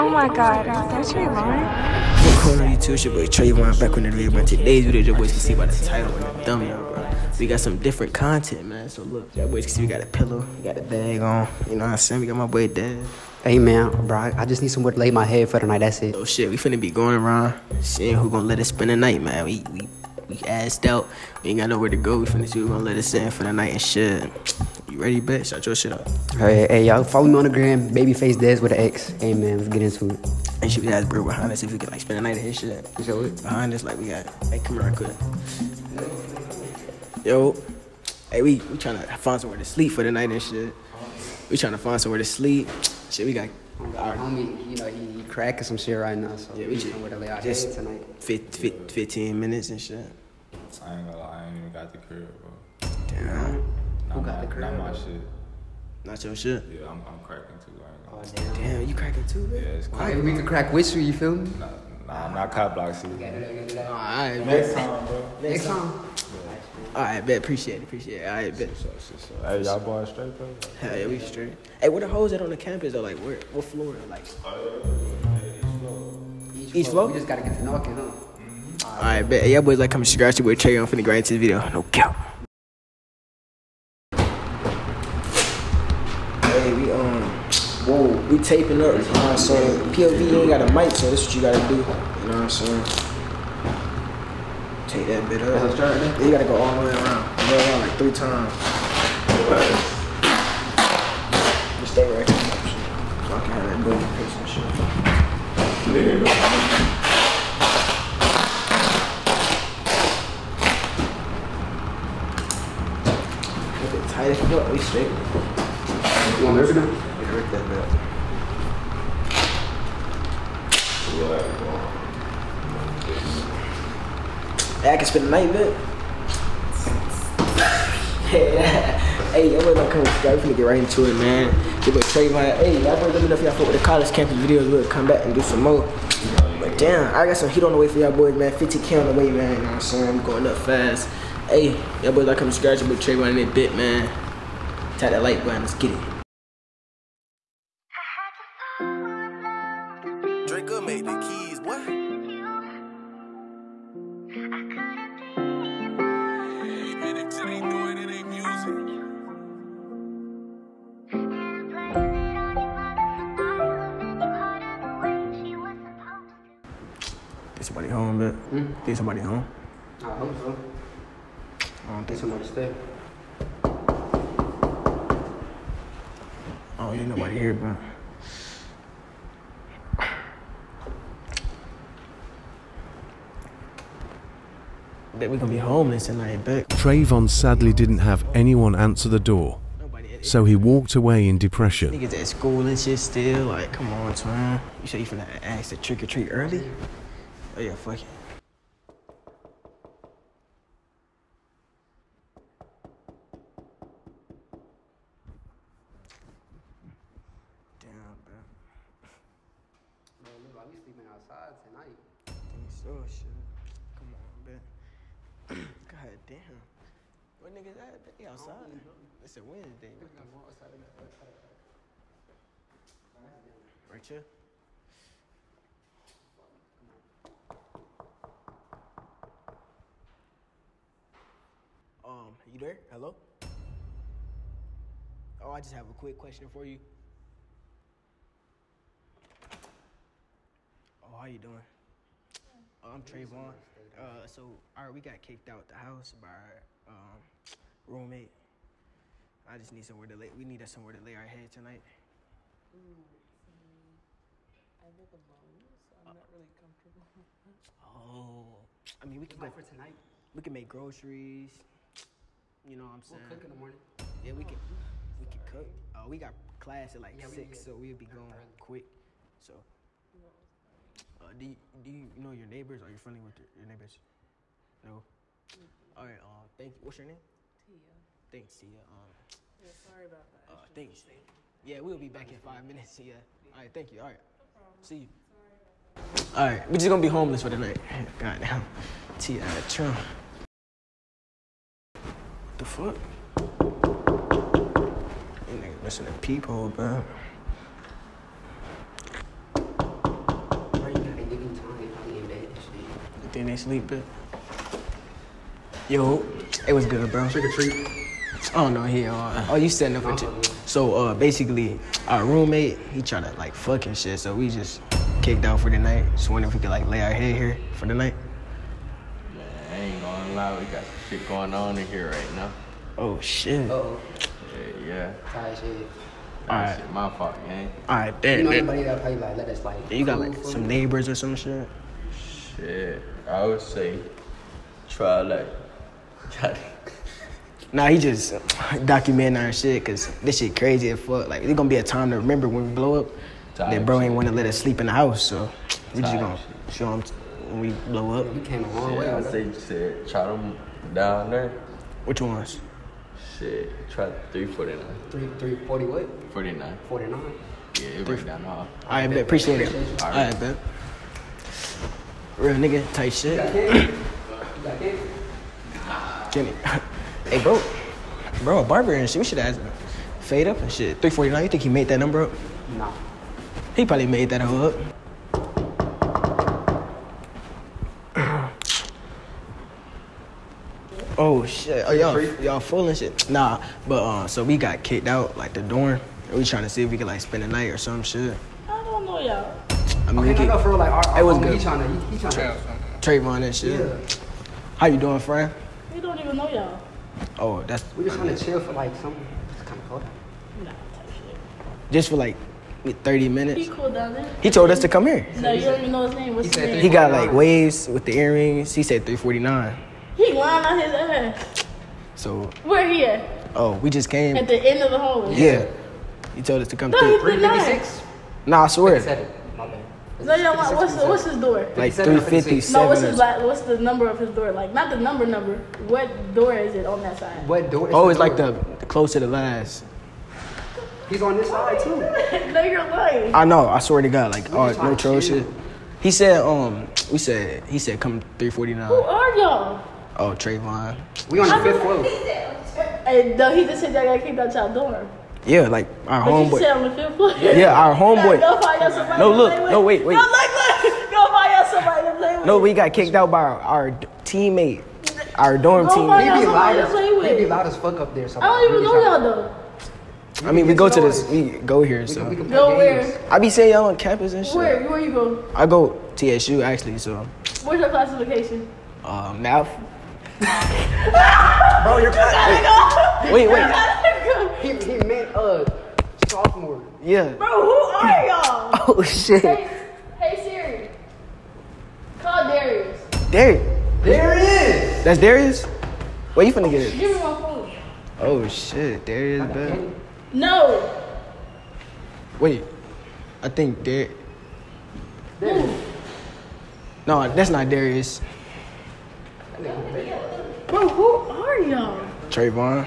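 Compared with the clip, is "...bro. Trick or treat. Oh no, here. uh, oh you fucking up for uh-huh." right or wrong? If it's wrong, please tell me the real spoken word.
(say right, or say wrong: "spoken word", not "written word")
wrong: "setting", not "fucking".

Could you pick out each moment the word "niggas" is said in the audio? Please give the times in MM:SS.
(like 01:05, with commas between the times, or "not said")
03:11, 03:37, 04:55, 06:02.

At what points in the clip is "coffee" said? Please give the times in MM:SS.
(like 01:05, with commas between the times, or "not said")
not said.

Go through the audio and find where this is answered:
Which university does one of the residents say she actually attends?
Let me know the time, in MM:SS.
07:46.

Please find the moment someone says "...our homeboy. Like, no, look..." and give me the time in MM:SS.
07:27.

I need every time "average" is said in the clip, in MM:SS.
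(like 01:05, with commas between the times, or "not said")
not said.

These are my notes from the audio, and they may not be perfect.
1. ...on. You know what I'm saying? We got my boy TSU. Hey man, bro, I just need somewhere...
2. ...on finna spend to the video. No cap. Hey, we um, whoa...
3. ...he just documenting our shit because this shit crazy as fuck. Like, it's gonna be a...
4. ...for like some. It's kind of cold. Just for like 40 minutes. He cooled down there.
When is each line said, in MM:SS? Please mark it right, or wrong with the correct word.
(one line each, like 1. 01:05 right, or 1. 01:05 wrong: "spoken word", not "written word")
1. 00:11 wrong: "Dev", not "TSU"
2. 01:20 wrong: "grind", not "spend"
3. 05:37 right
4. 06:38 wrong: "30", not "40".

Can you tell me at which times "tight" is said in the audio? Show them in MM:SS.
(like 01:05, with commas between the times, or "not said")
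01:54, 06:02.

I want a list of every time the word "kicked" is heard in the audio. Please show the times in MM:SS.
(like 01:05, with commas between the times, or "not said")
04:05, 05:15, 06:24, 07:32.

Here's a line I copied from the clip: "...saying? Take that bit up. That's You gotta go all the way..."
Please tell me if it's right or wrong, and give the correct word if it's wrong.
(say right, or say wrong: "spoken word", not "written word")
right.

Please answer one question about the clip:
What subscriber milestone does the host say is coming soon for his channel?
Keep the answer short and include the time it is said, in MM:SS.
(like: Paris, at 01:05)
50k, at 02:18.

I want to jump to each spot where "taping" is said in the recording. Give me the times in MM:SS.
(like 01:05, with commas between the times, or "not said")
01:28.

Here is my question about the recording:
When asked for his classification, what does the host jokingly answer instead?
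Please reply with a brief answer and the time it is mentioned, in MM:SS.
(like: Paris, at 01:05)
math, at 07:49.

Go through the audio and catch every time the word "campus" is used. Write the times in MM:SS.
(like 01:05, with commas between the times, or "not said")
01:12, 02:14, 07:43.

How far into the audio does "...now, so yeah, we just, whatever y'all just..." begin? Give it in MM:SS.
00:46.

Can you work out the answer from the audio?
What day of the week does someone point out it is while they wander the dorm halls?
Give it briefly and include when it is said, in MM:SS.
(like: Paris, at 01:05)
Wednesday, at 03:39.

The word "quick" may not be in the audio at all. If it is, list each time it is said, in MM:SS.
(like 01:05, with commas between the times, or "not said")
03:55, 04:28.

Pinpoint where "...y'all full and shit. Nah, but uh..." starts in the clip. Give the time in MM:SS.
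06:22.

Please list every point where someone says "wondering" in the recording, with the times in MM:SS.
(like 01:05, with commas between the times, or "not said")
05:16.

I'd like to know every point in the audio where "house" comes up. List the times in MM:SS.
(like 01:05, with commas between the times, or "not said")
04:05, 05:44.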